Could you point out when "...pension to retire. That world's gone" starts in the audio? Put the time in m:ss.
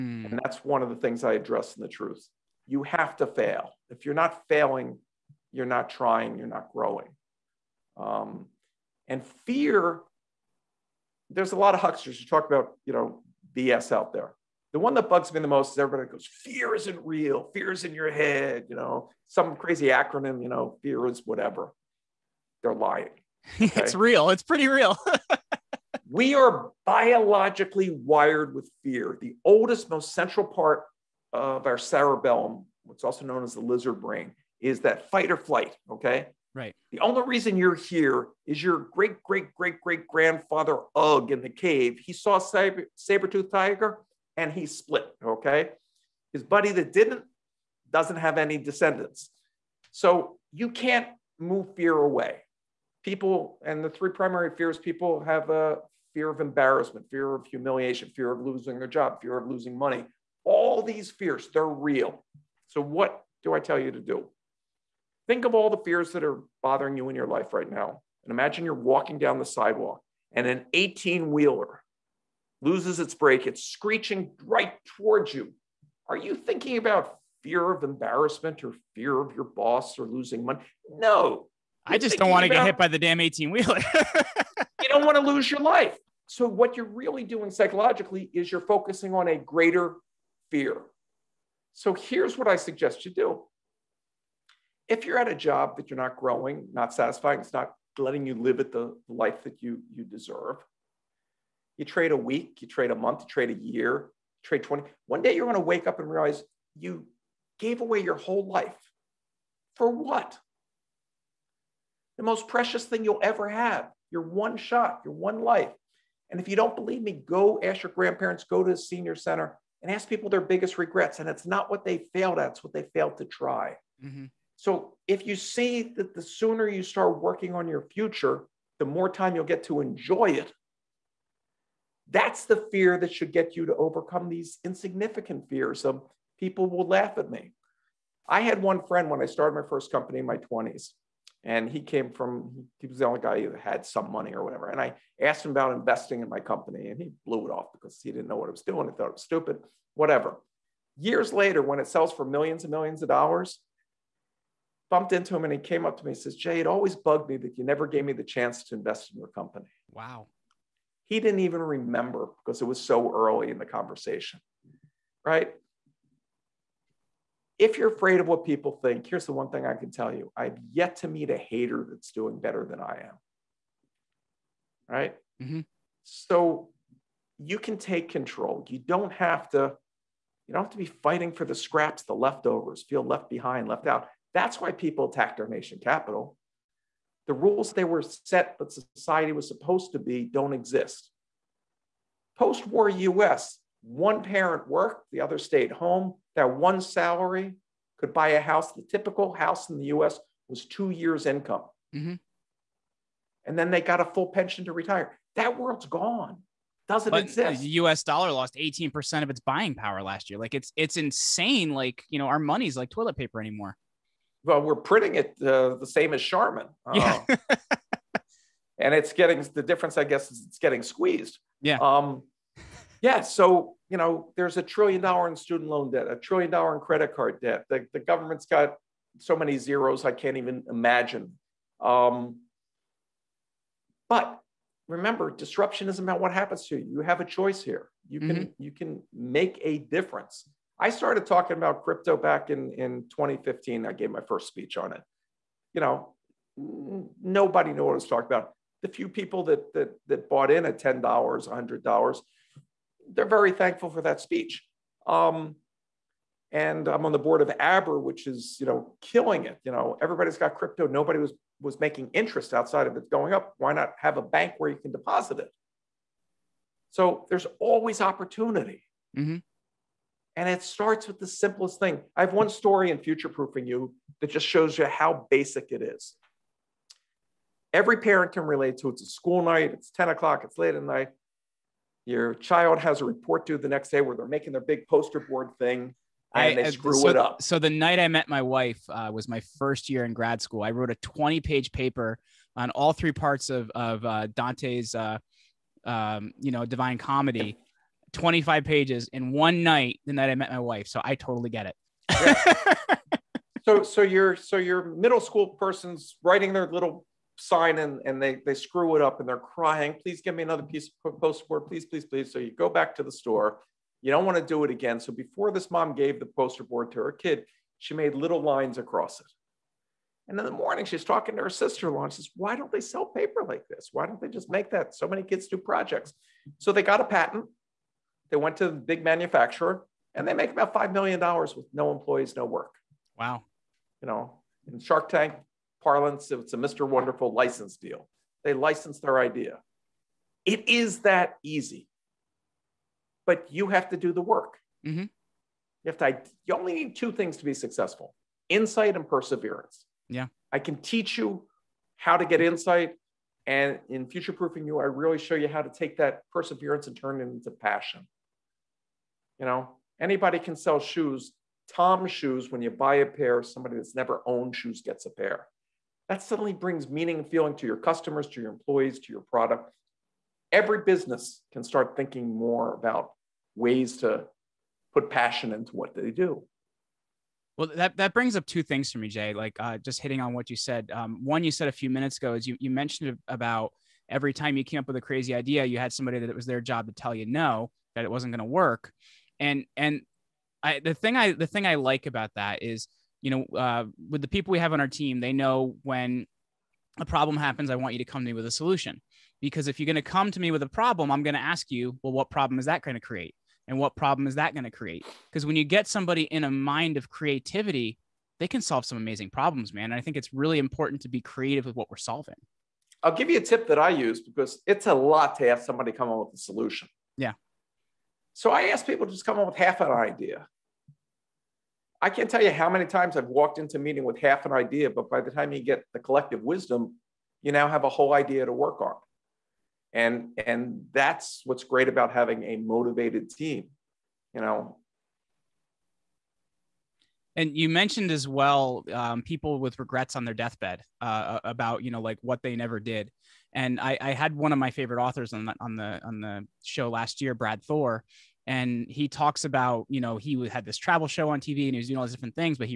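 3:24.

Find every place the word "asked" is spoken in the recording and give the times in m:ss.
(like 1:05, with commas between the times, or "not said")
2:25.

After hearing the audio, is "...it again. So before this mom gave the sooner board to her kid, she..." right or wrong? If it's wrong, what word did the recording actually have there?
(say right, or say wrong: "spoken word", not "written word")
wrong: "poster", not "sooner".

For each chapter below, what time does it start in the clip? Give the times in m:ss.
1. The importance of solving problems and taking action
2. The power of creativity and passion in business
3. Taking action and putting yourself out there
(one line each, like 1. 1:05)
1. 7:17
2. 6:17
3. 2:13.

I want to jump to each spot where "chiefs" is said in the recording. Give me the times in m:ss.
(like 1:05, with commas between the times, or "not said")
not said.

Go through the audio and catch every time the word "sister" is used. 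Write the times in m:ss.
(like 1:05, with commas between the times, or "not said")
5:21.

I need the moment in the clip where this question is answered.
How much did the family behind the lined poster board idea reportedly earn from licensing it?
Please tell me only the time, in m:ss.
5:30.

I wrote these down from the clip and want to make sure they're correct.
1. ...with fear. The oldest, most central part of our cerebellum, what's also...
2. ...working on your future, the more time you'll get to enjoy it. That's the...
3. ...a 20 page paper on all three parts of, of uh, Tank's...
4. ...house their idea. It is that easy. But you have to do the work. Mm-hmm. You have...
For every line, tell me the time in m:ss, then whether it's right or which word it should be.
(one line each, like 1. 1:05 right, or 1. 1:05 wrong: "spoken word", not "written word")
1. 0:28 right
2. 2:07 right
3. 4:50 wrong: "Dante", not "Tank"
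4. 5:38 wrong: "license", not "house".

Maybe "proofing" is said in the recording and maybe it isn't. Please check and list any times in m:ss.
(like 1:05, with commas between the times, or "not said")
4:33, 5:54.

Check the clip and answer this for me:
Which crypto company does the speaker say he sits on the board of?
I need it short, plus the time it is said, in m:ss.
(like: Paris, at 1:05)
Abra, at 4:17.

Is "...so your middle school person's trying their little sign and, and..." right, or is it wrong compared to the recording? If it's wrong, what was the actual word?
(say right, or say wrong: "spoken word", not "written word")
wrong: "writing", not "trying".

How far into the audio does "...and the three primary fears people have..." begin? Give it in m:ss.
0:53.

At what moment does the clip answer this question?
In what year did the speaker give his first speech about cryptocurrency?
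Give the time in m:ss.
4:03.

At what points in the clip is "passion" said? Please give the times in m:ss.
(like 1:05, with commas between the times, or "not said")
5:57, 6:15.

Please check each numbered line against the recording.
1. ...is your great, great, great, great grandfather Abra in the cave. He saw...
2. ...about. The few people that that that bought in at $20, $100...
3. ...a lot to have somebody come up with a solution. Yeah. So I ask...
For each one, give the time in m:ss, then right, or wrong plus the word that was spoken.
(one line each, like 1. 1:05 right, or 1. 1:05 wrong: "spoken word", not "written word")
1. 0:38 wrong: "Ugg", not "Abra"
2. 4:08 wrong: "10", not "20"
3. 6:54 right.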